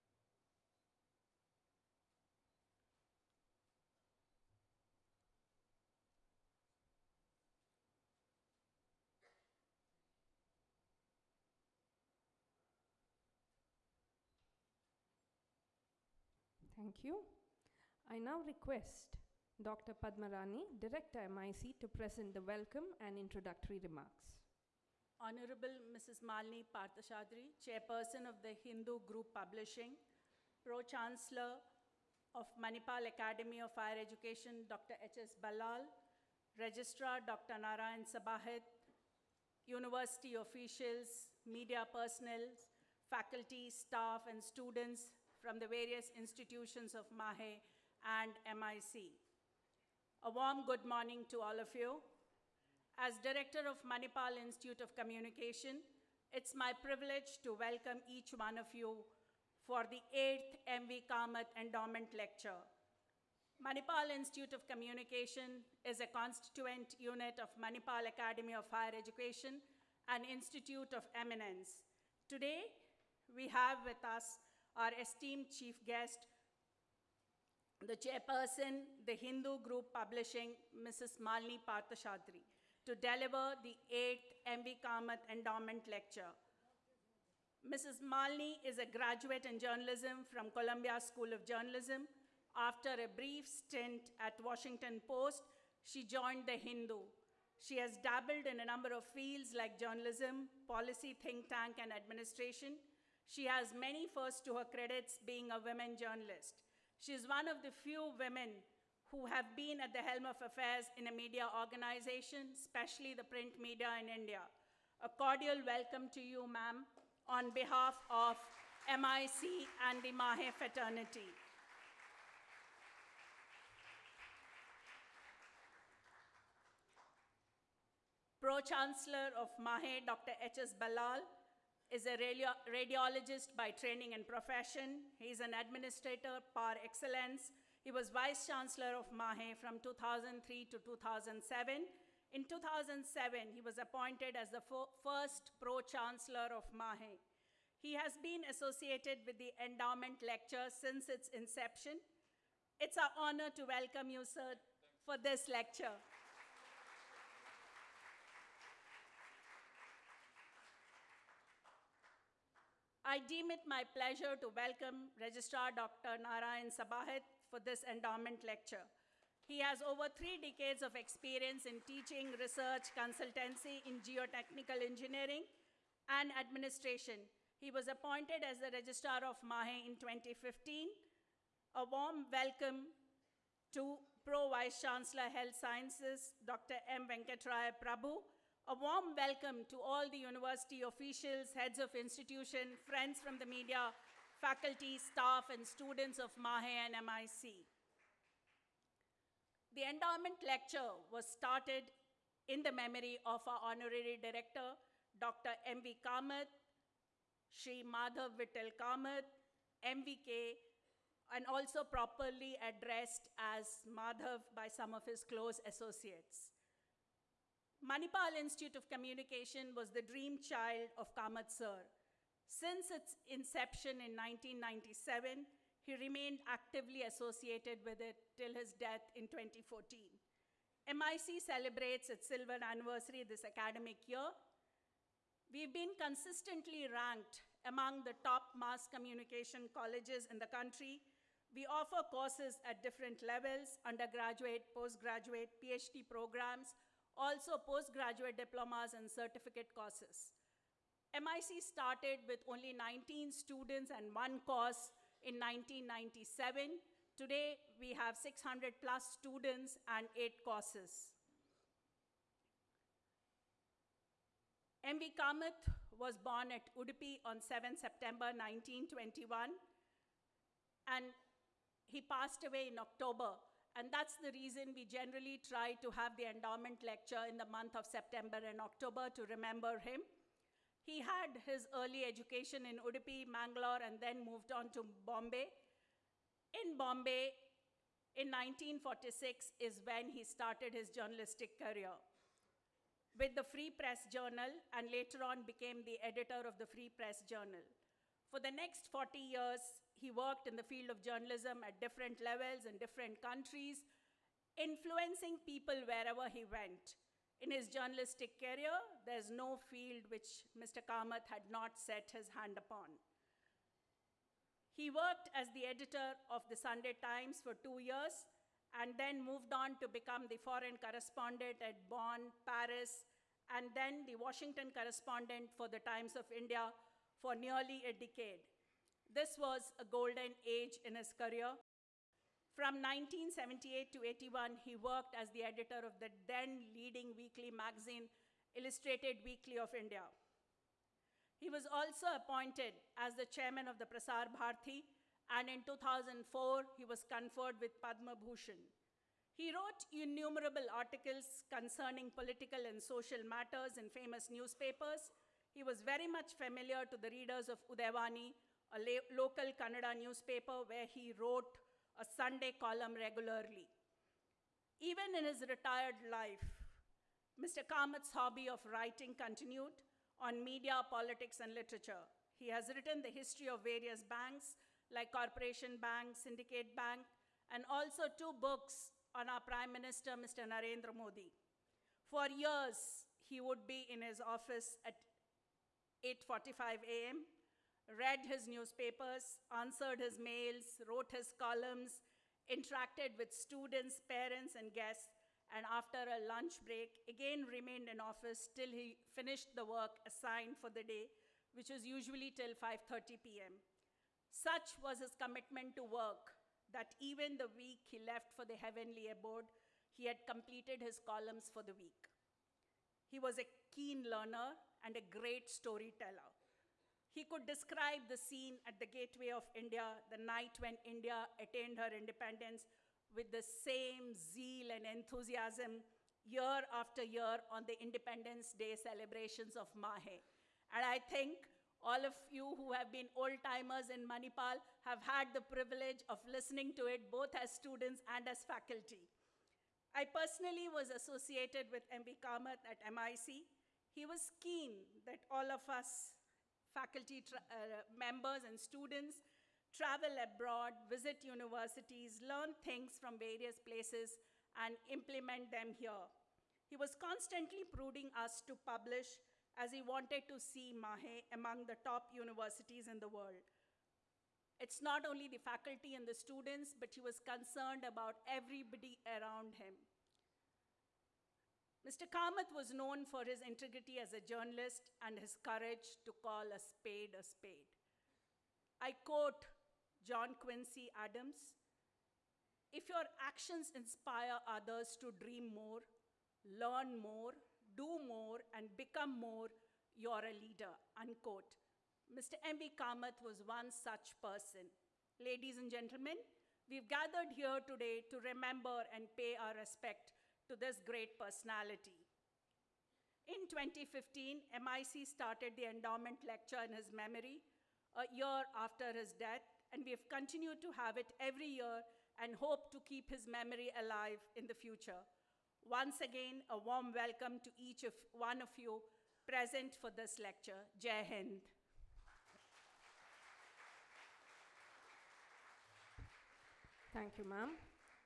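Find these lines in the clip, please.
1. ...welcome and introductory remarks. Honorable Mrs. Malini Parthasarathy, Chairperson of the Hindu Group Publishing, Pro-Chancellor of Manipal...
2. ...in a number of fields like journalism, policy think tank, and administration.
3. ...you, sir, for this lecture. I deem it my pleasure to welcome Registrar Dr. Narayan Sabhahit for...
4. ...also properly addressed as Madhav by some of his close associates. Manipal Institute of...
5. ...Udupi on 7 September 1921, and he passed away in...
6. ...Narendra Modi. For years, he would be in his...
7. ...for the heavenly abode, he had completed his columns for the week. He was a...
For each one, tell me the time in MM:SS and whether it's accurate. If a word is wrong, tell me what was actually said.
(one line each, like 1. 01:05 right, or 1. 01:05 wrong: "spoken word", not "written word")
1. 00:22 right
2. 01:38 right
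3. 02:34 right
4. 03:31 right
5. 04:26 right
6. 06:20 right
7. 06:48 right.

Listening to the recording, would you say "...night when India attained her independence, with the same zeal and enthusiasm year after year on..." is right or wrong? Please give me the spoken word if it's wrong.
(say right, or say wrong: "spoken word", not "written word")
right.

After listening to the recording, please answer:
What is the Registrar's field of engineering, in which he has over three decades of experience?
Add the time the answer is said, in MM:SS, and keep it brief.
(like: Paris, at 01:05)
Geotechnical engineering, at 02:54.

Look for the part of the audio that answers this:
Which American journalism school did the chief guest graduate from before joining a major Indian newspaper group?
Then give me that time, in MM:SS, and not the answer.
01:30.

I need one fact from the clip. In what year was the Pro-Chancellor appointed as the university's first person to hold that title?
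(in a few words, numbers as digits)
2007.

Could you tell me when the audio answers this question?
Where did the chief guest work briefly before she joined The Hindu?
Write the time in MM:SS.
01:34.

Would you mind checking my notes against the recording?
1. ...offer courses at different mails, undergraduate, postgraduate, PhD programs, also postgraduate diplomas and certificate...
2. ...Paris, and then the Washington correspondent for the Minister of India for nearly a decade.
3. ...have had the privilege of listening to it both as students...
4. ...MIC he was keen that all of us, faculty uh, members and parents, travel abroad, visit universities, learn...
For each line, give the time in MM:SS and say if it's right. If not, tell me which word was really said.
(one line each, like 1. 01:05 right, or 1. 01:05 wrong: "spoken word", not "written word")
1. 04:01 wrong: "levels", not "mails"
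2. 05:22 wrong: "Times", not "Minister"
3. 07:14 right
4. 07:22 wrong: "students", not "parents".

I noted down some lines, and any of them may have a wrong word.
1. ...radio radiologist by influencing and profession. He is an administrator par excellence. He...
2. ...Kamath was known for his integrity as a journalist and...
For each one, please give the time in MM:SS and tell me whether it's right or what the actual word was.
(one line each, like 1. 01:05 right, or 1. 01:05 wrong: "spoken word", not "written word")
1. 02:12 wrong: "training", not "influencing"
2. 07:52 right.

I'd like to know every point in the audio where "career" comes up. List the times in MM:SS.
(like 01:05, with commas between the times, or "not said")
04:51, 05:08, 05:31.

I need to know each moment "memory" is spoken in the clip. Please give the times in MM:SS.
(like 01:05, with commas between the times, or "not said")
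03:22, 08:26, 08:33.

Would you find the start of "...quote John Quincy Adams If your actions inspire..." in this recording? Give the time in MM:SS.
07:58.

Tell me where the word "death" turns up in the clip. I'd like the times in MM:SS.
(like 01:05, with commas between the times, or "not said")
03:48, 08:29.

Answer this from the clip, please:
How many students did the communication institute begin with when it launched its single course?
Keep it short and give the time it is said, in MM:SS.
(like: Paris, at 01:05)
19, at 04:12.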